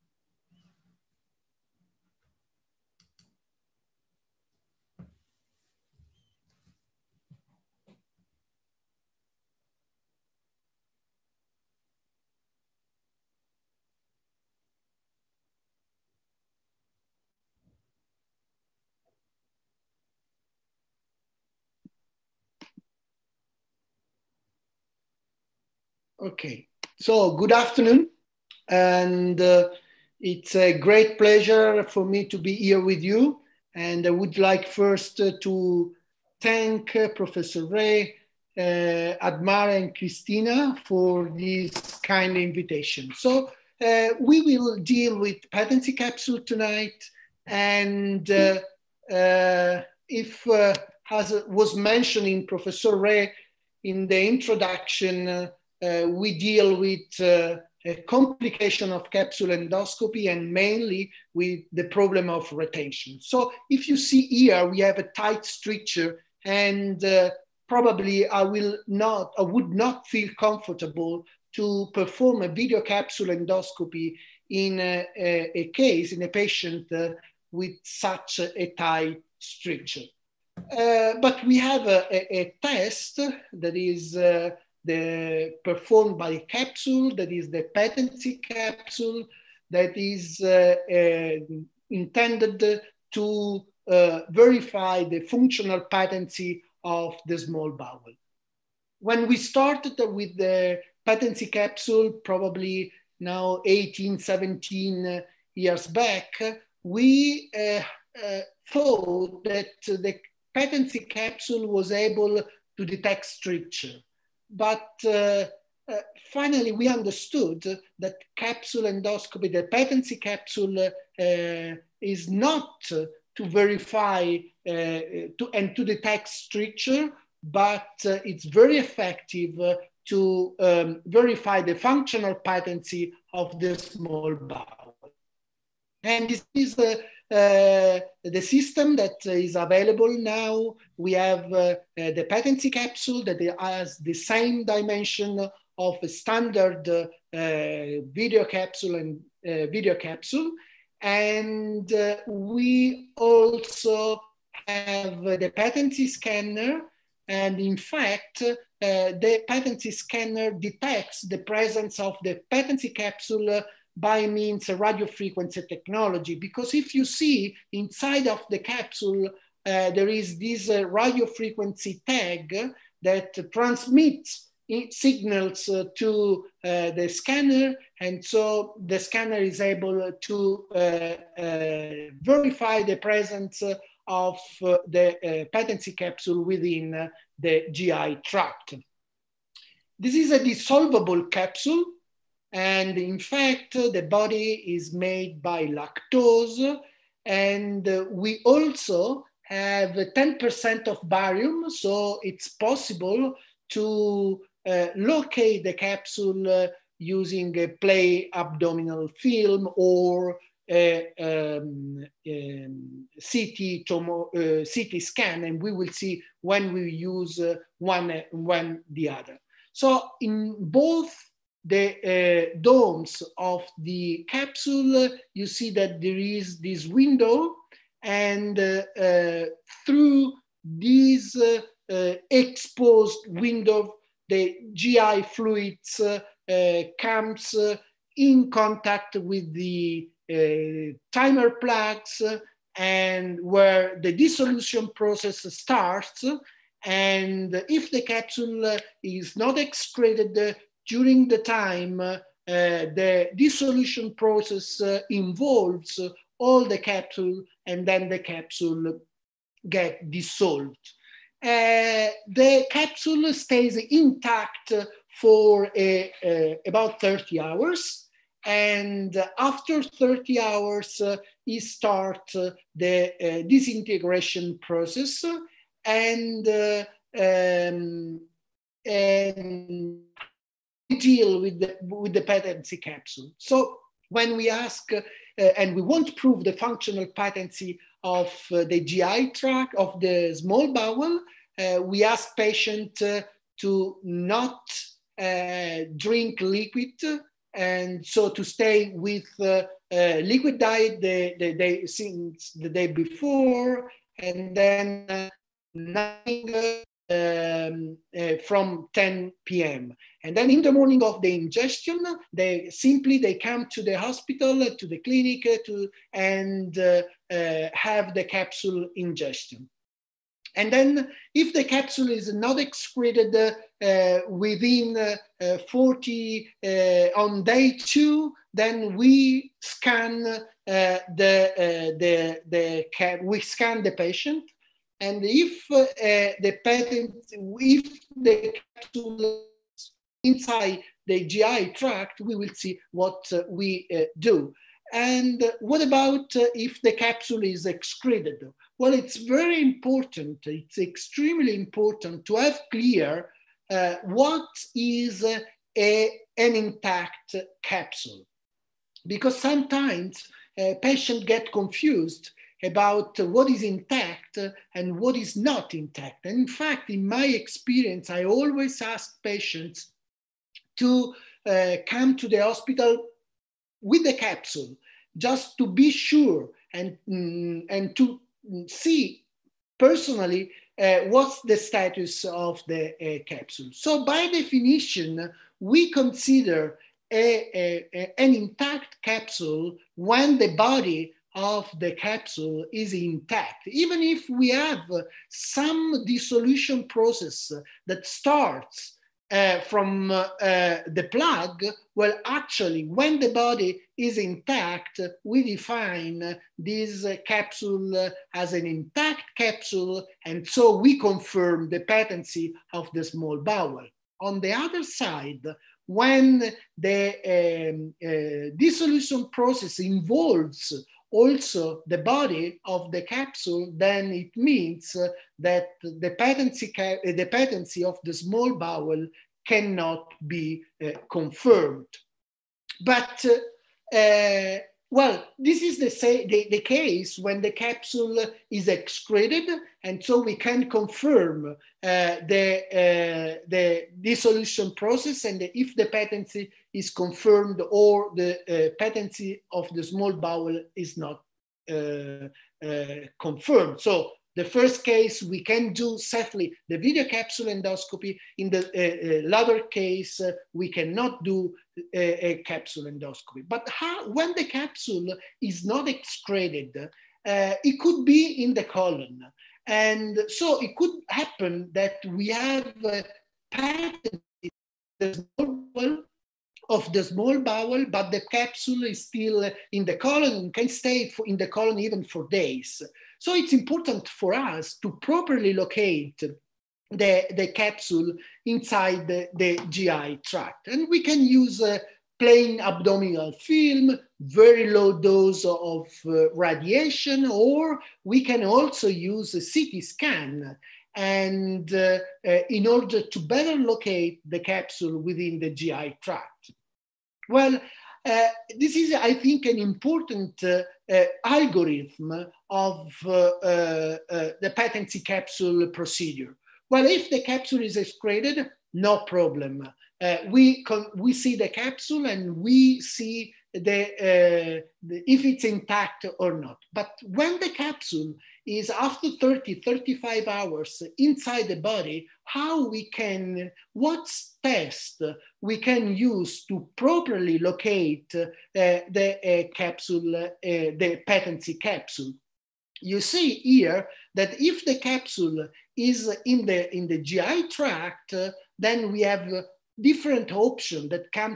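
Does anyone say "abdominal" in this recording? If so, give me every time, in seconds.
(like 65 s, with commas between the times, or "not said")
208 s, 492 s.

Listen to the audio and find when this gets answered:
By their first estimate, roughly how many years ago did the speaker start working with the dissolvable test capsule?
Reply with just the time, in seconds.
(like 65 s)
103 s.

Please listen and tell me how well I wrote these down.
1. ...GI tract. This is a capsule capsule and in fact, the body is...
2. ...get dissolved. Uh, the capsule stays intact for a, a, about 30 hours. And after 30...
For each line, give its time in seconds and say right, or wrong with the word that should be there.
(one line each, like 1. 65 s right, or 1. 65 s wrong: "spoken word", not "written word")
1. 187 s wrong: "dissolvable", not "capsule"
2. 259 s right.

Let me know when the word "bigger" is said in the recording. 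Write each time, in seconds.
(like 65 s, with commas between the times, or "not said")
not said.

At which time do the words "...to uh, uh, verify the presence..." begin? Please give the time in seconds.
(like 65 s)
180 s.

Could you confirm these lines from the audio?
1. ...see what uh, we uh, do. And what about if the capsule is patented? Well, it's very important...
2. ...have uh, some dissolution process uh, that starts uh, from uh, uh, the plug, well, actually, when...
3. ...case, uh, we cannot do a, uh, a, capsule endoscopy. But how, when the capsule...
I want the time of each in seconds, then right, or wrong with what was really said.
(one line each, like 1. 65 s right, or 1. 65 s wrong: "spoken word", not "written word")
1. 342 s wrong: "excreted", not "patented"
2. 394 s right
3. 459 s right.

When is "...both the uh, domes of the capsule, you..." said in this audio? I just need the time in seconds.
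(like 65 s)
220 s.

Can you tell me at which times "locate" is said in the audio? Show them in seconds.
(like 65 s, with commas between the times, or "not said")
204 s, 485 s, 503 s, 537 s.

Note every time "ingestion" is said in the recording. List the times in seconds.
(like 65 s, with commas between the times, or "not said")
311 s, 318 s.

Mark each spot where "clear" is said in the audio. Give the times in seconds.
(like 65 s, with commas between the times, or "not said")
352 s.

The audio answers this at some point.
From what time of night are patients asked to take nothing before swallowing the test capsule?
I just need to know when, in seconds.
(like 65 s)
308 s.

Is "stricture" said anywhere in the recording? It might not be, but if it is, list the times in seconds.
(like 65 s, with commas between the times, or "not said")
65 s, 79 s, 113 s, 126 s.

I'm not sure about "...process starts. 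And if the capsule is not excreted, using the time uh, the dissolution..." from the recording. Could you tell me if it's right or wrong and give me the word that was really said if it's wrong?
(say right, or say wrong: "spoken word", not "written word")
wrong: "during", not "using".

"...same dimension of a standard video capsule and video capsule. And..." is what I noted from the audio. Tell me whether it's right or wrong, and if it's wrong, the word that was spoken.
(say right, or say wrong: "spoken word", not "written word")
right.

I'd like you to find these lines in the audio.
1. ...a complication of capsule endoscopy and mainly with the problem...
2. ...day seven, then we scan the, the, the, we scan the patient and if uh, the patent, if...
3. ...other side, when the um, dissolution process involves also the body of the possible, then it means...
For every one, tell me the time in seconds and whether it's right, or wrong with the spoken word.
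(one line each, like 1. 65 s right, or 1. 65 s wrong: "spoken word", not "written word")
1. 57 s right
2. 327 s wrong: "two", not "seven"
3. 414 s wrong: "capsule", not "possible".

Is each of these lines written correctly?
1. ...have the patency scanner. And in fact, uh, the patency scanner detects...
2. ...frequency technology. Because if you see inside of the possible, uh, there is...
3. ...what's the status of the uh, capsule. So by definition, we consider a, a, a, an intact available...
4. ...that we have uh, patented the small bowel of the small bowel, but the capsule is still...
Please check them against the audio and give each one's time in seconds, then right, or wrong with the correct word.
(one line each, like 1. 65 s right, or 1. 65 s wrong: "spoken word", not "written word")
1. 154 s right
2. 165 s wrong: "capsule", not "possible"
3. 381 s wrong: "capsule", not "available"
4. 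471 s right.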